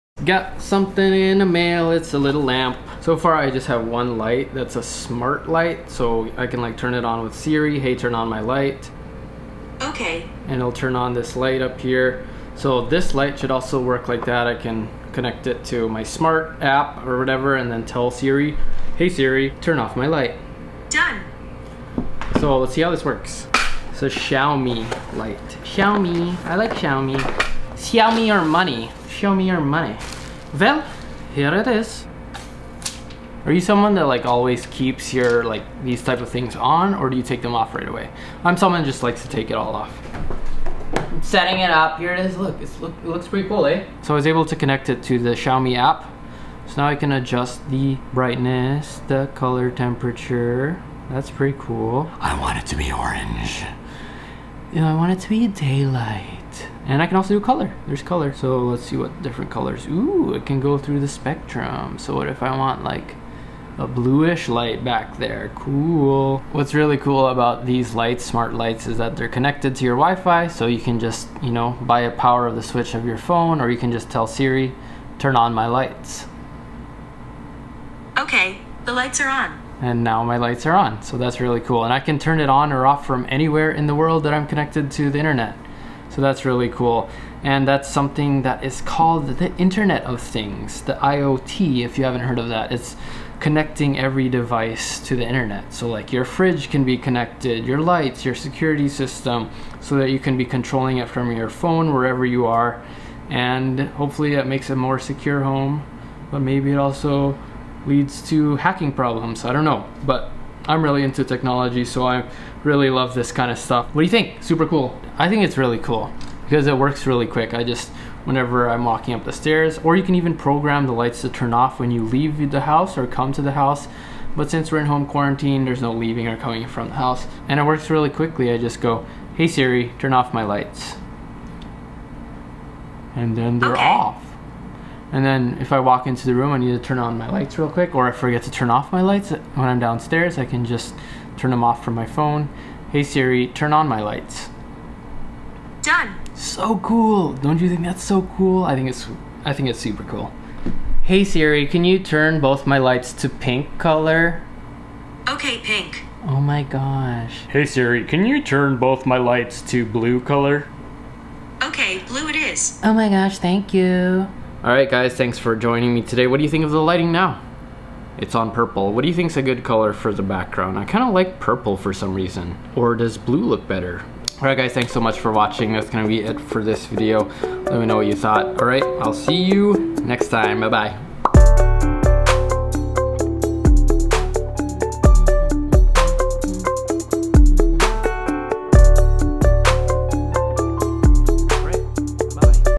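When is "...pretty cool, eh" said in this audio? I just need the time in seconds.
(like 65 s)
43 s.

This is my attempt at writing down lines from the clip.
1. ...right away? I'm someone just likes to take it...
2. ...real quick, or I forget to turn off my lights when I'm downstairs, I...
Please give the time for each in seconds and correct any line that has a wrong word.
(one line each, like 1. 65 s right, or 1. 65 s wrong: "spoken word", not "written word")
1. 37 s right
2. 137 s right.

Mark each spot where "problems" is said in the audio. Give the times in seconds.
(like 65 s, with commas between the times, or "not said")
108 s.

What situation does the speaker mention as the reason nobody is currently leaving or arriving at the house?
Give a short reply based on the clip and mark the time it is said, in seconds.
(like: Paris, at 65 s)
home quarantine, at 124 s.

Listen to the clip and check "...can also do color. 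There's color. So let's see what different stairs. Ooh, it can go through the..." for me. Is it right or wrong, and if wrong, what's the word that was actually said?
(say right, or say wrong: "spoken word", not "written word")
wrong: "colors", not "stairs".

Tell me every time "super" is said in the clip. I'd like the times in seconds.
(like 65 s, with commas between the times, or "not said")
114 s, 149 s.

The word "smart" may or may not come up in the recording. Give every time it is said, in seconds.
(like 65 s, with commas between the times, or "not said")
4 s, 16 s, 68 s.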